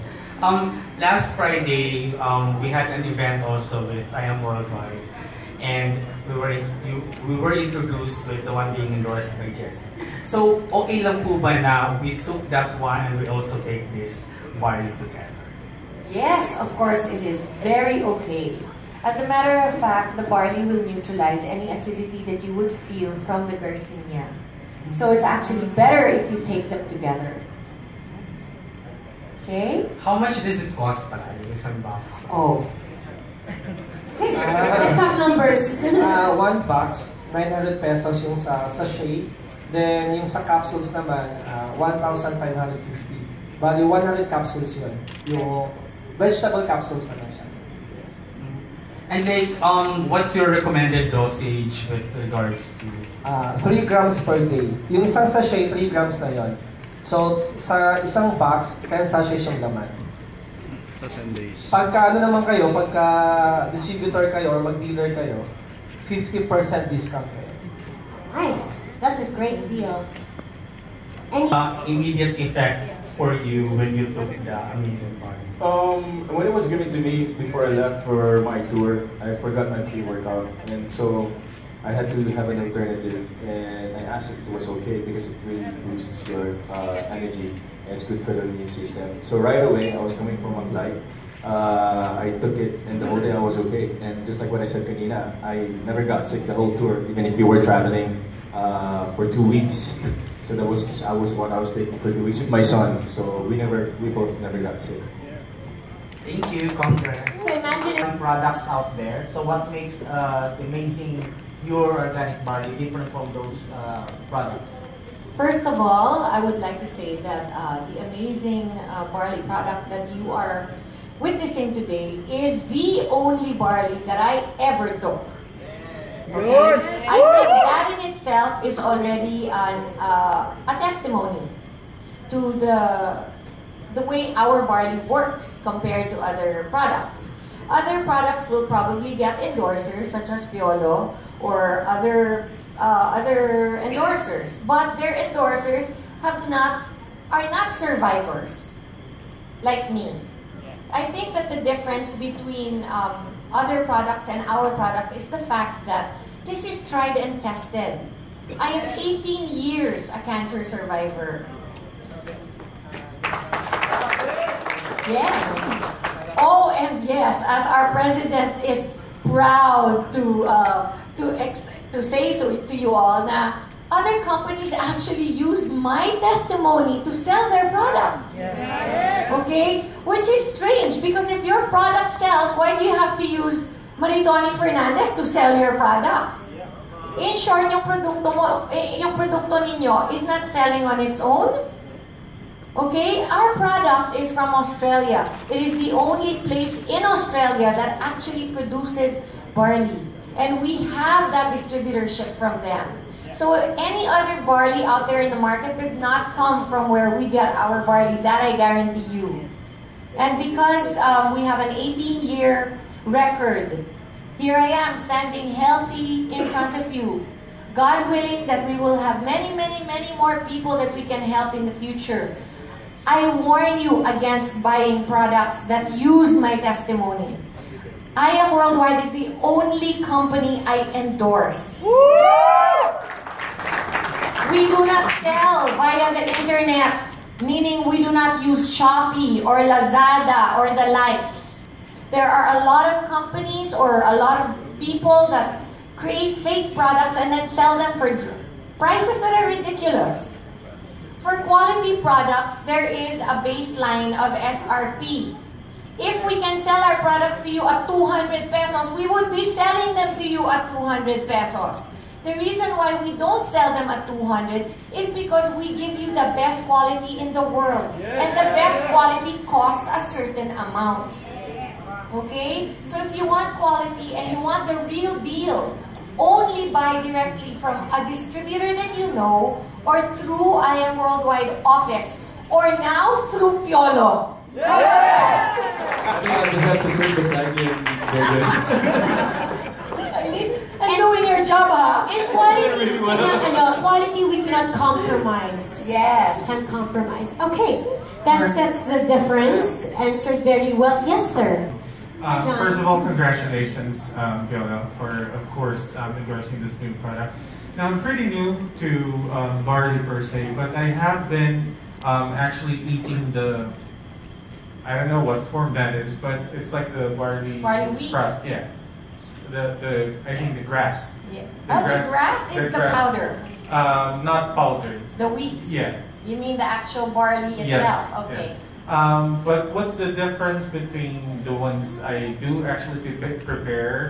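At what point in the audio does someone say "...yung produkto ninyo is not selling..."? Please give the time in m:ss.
3:09.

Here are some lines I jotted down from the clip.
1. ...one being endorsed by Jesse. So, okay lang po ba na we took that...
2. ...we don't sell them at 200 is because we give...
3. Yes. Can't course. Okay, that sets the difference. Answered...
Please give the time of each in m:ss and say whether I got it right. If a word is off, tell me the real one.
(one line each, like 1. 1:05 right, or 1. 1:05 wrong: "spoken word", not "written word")
1. 0:08 right
2. 4:23 right
3. 4:55 wrong: "compromise", not "course".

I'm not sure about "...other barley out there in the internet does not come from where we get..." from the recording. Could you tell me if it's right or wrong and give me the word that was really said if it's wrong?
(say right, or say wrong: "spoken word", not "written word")
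wrong: "market", not "internet".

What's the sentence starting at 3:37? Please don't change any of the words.
God willing that we will have many, many, many more people that we can help in the future.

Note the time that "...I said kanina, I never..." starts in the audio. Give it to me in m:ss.
1:34.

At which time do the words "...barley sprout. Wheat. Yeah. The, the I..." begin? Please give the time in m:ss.
5:17.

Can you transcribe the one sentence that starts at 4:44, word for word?
I think I just have to sit beside you and go good.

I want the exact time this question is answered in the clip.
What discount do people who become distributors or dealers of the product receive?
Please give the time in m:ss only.
1:06.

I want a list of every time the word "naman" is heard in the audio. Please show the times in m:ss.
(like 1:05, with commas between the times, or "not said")
0:40, 0:47, 1:02.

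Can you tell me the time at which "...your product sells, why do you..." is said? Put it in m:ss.
3:01.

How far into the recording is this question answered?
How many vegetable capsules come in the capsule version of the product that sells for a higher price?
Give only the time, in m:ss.
0:43.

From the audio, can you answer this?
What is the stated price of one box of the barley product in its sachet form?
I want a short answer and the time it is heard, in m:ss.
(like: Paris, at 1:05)
900 pesos, at 0:37.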